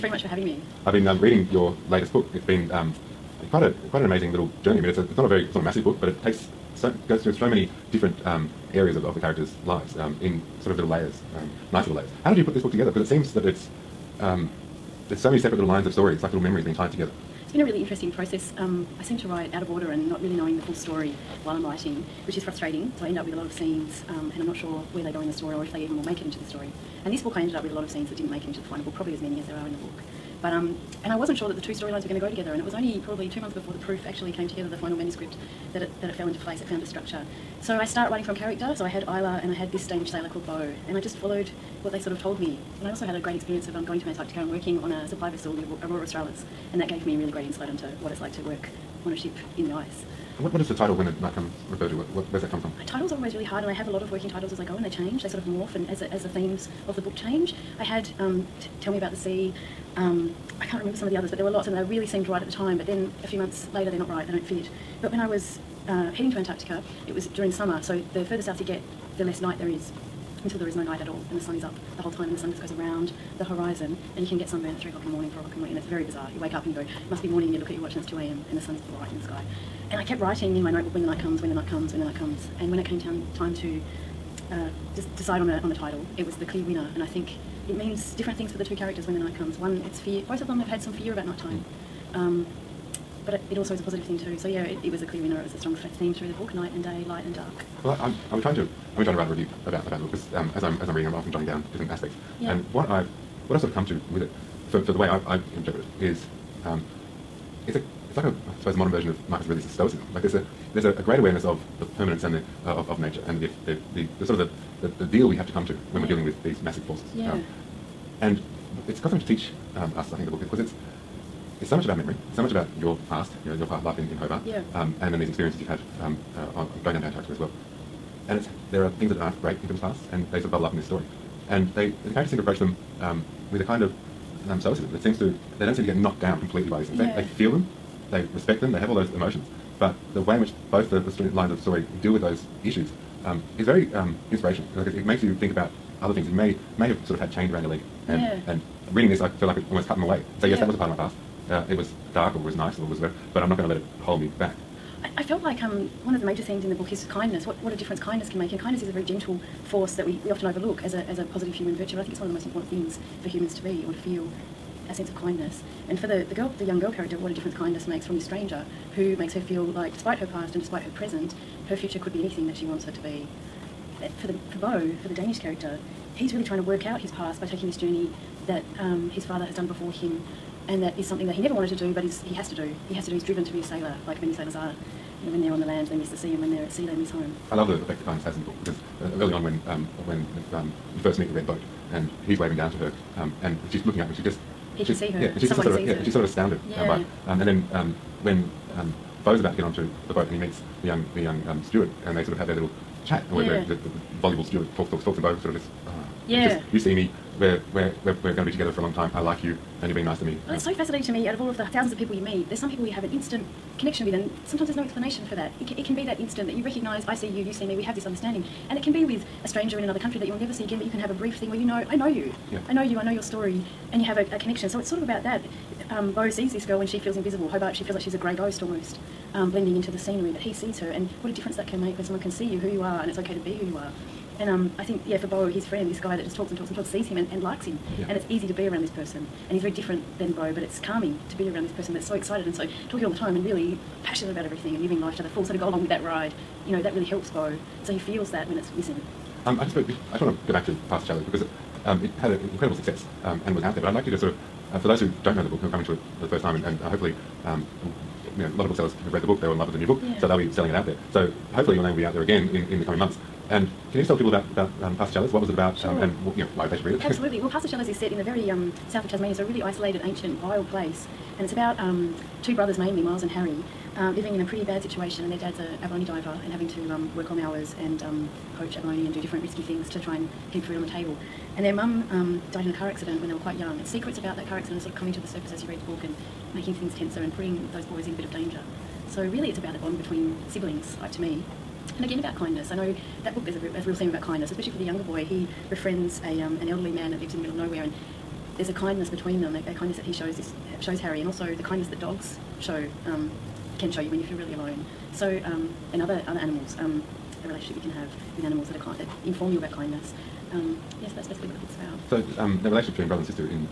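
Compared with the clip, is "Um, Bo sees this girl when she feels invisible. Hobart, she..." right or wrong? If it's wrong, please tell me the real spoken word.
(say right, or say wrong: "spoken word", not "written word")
right.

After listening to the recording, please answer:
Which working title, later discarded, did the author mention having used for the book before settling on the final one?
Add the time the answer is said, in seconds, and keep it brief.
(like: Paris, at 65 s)
Tell Me About the Sea, at 58 s.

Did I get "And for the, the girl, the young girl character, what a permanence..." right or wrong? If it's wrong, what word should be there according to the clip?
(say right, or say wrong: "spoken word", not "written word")
wrong: "difference", not "permanence".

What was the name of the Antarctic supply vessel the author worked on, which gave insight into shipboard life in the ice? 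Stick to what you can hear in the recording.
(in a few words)
Aurora Australis.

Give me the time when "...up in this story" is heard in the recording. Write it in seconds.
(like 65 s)
130 s.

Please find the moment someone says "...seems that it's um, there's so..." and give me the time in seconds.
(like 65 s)
13 s.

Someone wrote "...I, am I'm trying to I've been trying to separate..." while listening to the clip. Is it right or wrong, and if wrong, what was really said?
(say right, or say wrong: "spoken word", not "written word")
wrong: "write", not "separate".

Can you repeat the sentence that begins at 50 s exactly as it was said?
what, what is the title when it might come refer to?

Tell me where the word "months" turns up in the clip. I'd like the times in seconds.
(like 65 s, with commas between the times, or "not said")
33 s, 63 s, 262 s.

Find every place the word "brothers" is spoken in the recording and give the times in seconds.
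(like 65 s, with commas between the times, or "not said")
272 s, 313 s.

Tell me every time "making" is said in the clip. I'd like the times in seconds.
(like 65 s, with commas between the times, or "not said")
286 s.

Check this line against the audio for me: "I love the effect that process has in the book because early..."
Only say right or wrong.
wrong.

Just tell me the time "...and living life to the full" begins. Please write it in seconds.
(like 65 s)
244 s.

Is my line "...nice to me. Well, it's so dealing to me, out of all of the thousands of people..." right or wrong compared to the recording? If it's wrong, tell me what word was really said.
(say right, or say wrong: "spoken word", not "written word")
wrong: "fascinating", not "dealing".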